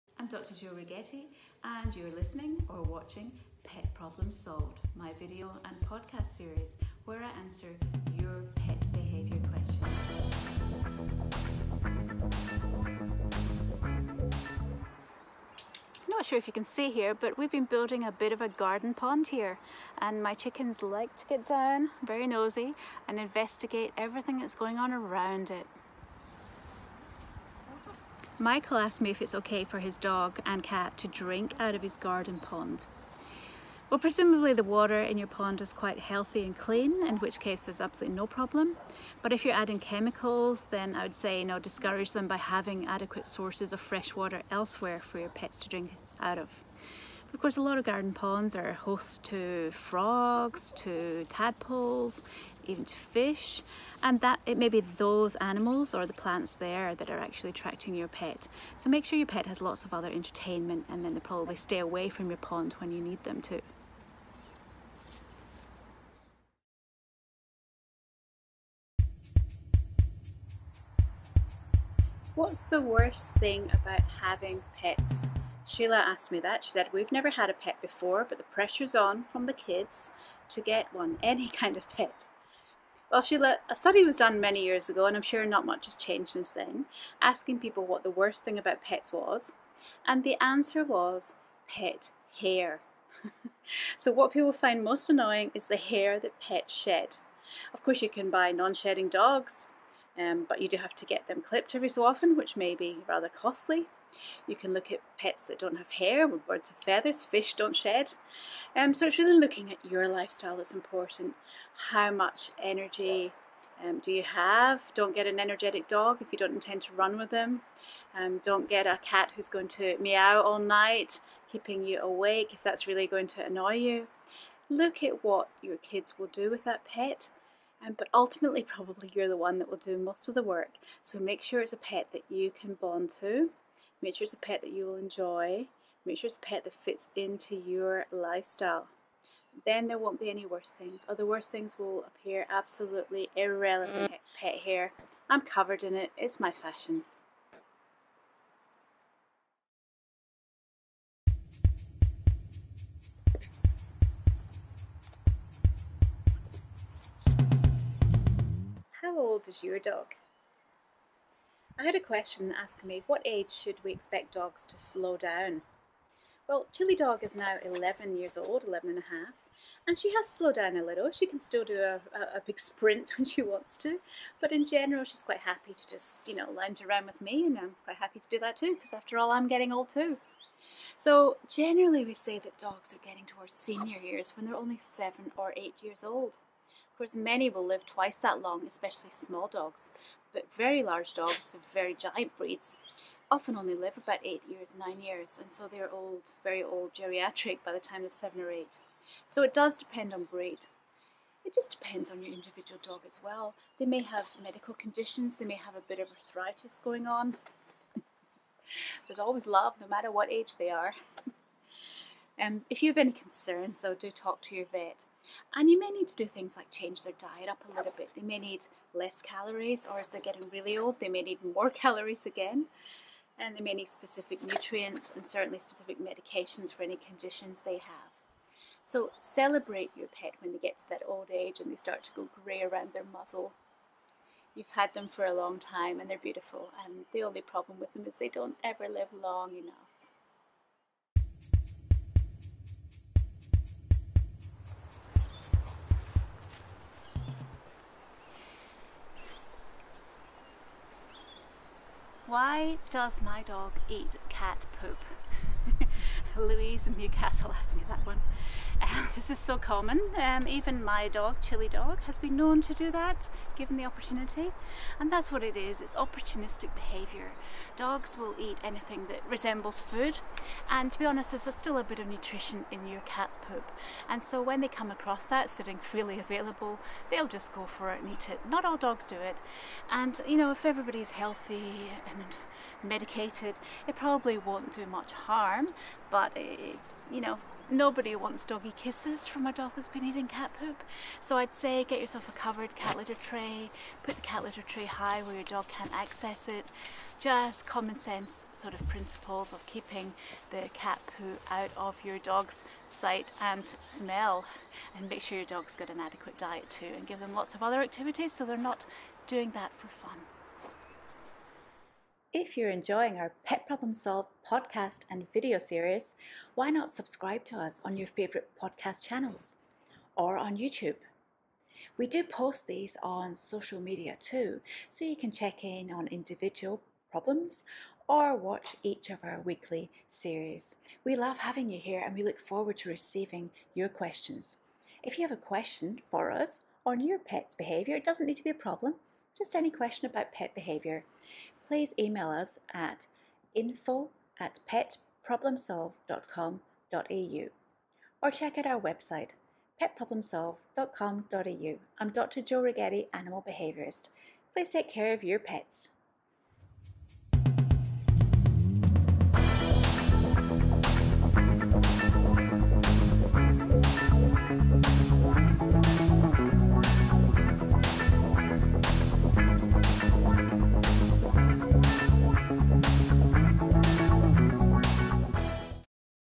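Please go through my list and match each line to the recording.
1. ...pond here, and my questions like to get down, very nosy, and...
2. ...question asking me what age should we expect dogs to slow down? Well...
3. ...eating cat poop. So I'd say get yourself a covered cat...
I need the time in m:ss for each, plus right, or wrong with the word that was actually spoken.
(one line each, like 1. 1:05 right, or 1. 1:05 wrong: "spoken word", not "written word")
1. 0:18 wrong: "chickens", not "questions"
2. 2:41 right
3. 4:50 right.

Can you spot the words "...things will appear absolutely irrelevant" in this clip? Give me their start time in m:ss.
2:21.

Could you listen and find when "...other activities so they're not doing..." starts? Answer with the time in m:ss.
5:07.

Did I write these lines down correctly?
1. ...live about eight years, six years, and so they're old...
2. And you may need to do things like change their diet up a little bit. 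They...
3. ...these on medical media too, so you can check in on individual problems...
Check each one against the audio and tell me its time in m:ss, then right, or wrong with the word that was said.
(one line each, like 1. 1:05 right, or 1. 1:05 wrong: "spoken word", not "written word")
1. 3:13 wrong: "nine", not "six"
2. 3:35 right
3. 5:22 wrong: "social", not "medical".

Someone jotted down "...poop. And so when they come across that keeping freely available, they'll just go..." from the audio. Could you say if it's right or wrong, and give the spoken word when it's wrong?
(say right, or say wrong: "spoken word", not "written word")
wrong: "sitting", not "keeping".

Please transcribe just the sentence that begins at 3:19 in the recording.
So it does depend on breed.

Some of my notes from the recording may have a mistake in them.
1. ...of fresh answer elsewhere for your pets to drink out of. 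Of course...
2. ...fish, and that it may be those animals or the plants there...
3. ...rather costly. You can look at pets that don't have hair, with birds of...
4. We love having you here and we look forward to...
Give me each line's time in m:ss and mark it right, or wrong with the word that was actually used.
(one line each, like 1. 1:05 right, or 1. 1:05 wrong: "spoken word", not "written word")
1. 0:43 wrong: "water", not "answer"
2. 0:52 right
3. 1:43 right
4. 5:31 right.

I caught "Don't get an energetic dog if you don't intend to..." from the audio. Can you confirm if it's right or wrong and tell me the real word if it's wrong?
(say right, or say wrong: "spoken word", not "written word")
right.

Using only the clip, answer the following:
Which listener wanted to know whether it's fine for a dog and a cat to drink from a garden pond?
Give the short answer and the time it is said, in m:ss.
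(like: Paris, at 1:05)
Michael, at 0:28.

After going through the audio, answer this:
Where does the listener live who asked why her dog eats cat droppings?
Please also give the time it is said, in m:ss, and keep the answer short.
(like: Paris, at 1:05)
Newcastle, at 4:16.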